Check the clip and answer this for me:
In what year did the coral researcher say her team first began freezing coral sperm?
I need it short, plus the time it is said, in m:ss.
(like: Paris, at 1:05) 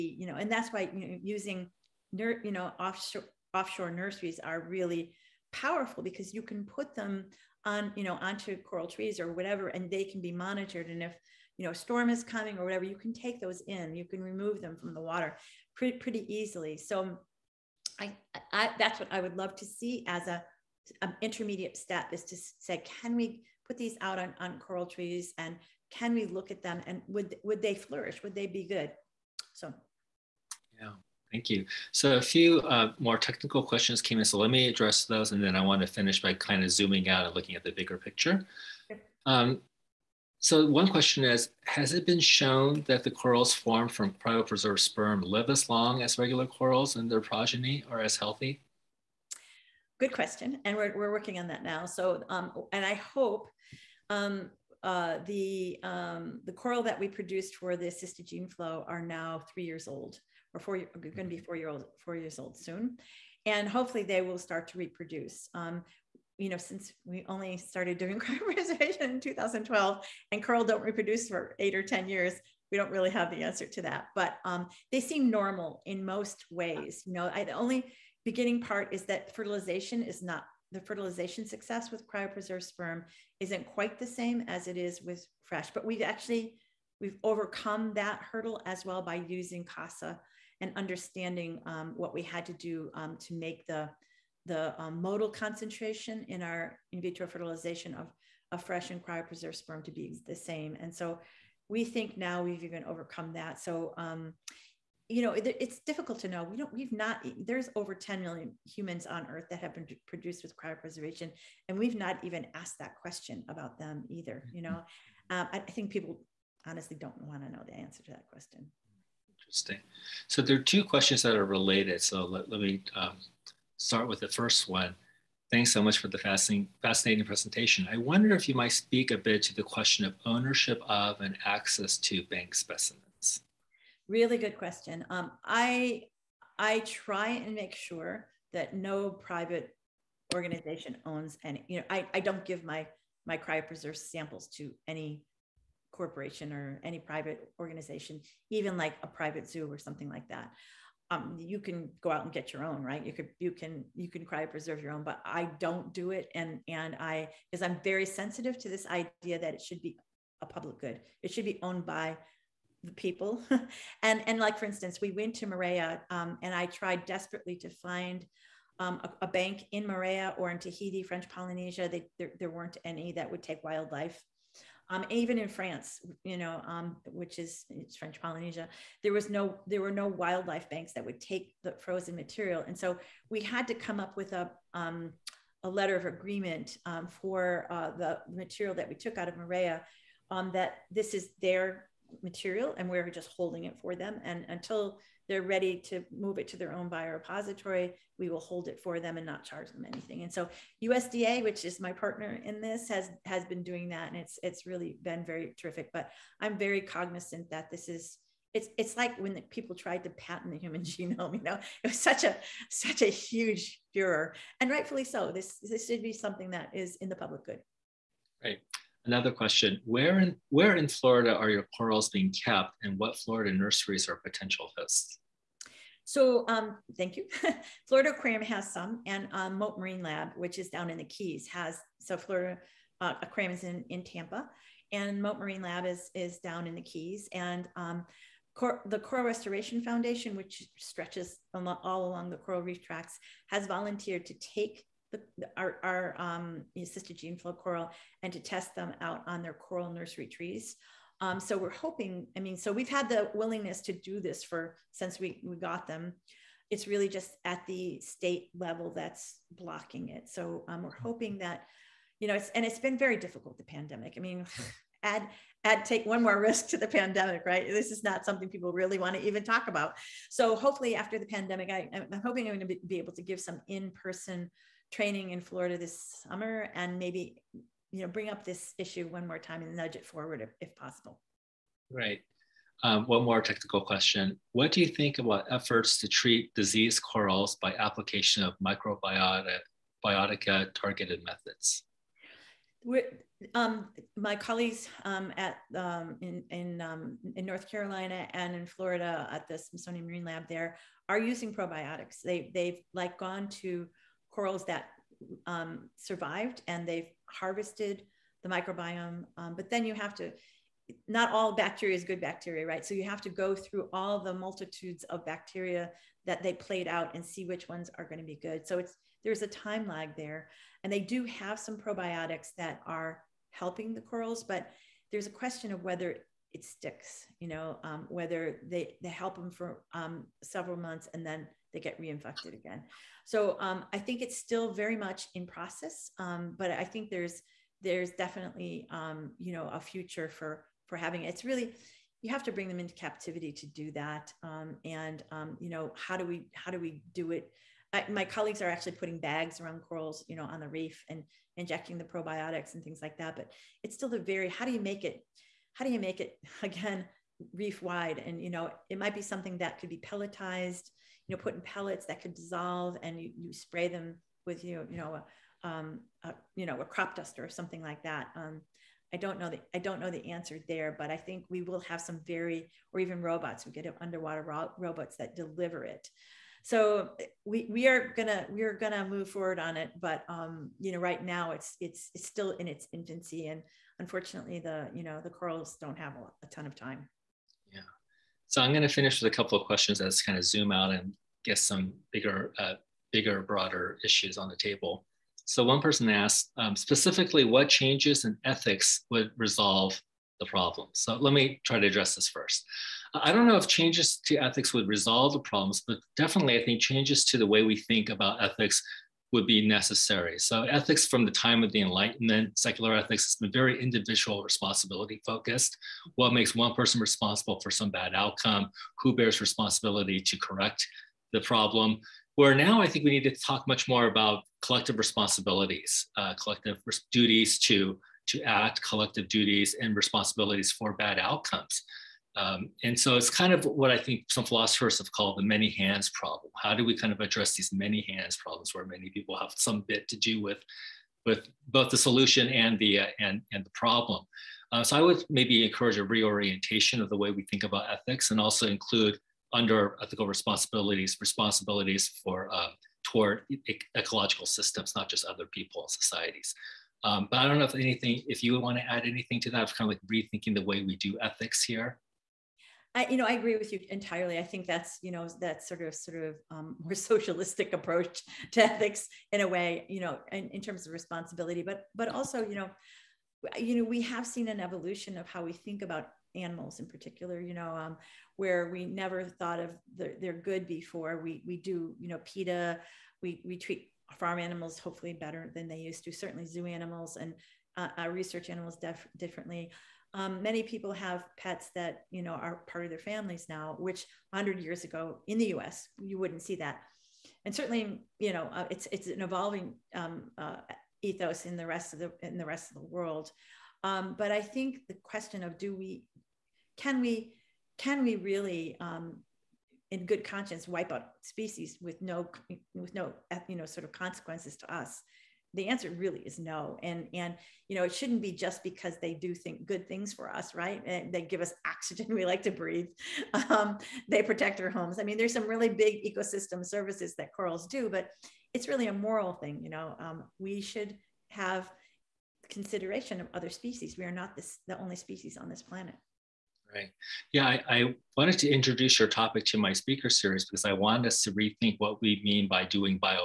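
2012, at 1:09.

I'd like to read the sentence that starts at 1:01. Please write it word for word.
four year old, four years old soon, and hopefully they will start to reproduce.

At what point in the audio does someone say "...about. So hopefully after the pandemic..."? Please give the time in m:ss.
4:29.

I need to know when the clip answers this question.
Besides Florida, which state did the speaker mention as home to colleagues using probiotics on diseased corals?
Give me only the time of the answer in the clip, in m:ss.
4:57.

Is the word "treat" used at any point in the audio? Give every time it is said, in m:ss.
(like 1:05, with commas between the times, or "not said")
4:46, 8:03.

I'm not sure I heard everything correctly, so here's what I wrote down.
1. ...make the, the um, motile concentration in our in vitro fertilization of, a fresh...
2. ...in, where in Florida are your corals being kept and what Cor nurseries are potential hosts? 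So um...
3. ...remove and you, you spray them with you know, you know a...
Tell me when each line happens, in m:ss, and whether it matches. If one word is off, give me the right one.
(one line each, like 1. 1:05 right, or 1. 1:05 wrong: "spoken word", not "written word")
1. 1:33 right
2. 3:40 wrong: "Florida", not "Cor"
3. 6:02 wrong: "dissolve", not "remove".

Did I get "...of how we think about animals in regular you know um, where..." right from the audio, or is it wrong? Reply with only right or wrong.
wrong.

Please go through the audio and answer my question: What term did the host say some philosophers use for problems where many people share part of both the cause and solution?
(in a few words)
many hands problem.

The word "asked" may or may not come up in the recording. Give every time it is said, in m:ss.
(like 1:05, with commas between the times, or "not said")
1:52, 6:36.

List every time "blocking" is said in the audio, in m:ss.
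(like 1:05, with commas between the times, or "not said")
4:19.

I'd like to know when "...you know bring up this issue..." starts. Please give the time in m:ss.
4:37.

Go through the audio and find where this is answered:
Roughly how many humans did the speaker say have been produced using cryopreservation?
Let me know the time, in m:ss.
1:47.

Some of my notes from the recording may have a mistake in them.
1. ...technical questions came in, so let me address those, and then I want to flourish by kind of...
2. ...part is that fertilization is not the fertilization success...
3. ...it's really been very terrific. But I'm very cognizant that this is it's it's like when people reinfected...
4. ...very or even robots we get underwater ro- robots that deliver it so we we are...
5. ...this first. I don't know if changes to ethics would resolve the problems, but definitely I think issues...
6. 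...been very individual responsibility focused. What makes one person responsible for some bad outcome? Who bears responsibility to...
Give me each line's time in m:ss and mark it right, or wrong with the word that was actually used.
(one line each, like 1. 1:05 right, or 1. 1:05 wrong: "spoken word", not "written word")
1. 0:33 wrong: "finish", not "flourish"
2. 1:18 right
3. 3:24 wrong: "tried", not "reinfected"
4. 6:12 right
5. 6:42 wrong: "changes", not "issues"
6. 6:53 right.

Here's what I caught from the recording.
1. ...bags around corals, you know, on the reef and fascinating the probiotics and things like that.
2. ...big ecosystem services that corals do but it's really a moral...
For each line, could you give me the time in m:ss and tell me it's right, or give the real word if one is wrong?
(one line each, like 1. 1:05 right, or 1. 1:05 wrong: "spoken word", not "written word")
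1. 5:49 wrong: "injecting", not "fascinating"
2. 8:45 right.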